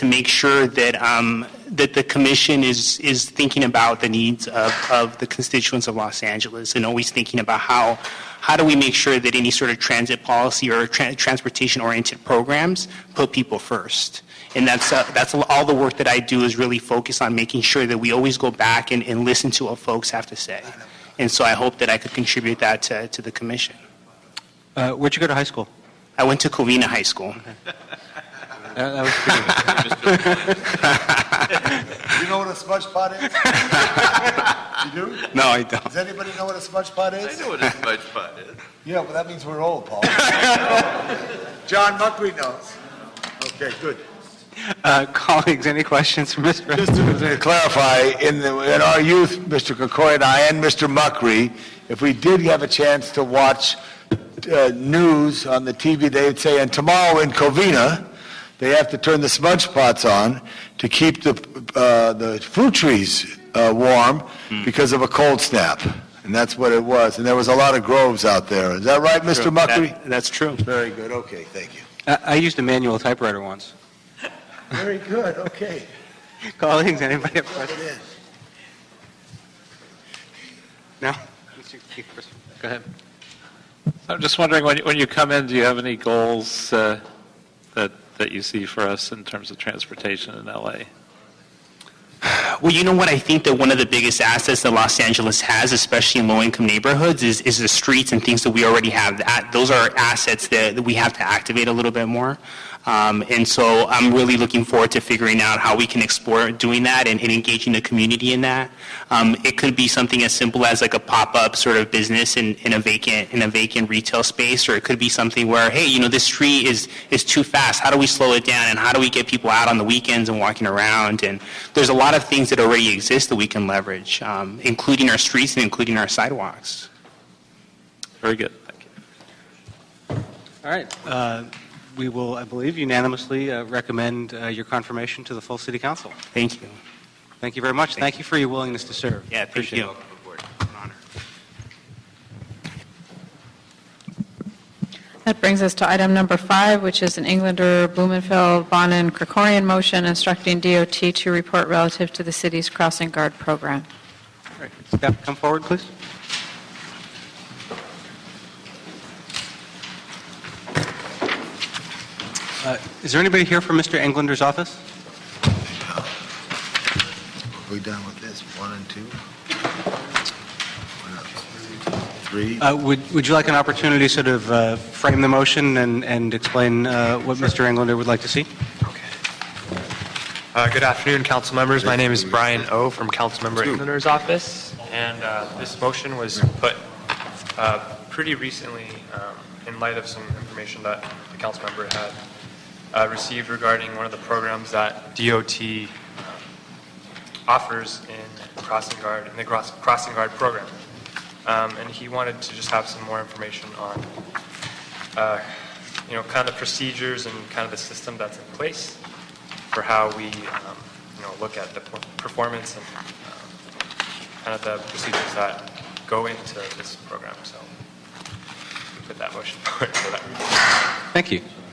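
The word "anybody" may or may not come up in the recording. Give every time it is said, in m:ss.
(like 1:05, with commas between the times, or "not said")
0:35, 1:17, 2:43.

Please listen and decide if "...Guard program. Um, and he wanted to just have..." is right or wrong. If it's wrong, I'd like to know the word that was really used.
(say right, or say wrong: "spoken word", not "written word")
right.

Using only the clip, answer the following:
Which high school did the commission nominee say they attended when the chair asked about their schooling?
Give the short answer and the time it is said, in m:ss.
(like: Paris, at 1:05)
Covina High School, at 0:26.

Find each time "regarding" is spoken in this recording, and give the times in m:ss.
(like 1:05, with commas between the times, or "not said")
3:13.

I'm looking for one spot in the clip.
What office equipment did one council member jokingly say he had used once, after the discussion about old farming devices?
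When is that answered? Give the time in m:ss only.
1:12.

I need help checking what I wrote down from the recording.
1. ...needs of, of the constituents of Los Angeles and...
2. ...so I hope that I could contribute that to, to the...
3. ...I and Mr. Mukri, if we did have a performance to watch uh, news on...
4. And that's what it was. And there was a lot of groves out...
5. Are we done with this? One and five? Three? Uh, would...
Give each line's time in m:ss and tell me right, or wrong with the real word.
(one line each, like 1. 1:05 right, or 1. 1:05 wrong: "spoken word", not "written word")
1. 0:04 right
2. 0:21 right
3. 0:50 wrong: "chance", not "performance"
4. 1:06 right
5. 2:45 wrong: "two", not "five".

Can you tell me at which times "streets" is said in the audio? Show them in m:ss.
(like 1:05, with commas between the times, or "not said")
1:37, 1:56, 2:05.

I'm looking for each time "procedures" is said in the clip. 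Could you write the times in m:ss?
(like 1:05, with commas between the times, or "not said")
3:26, 3:34.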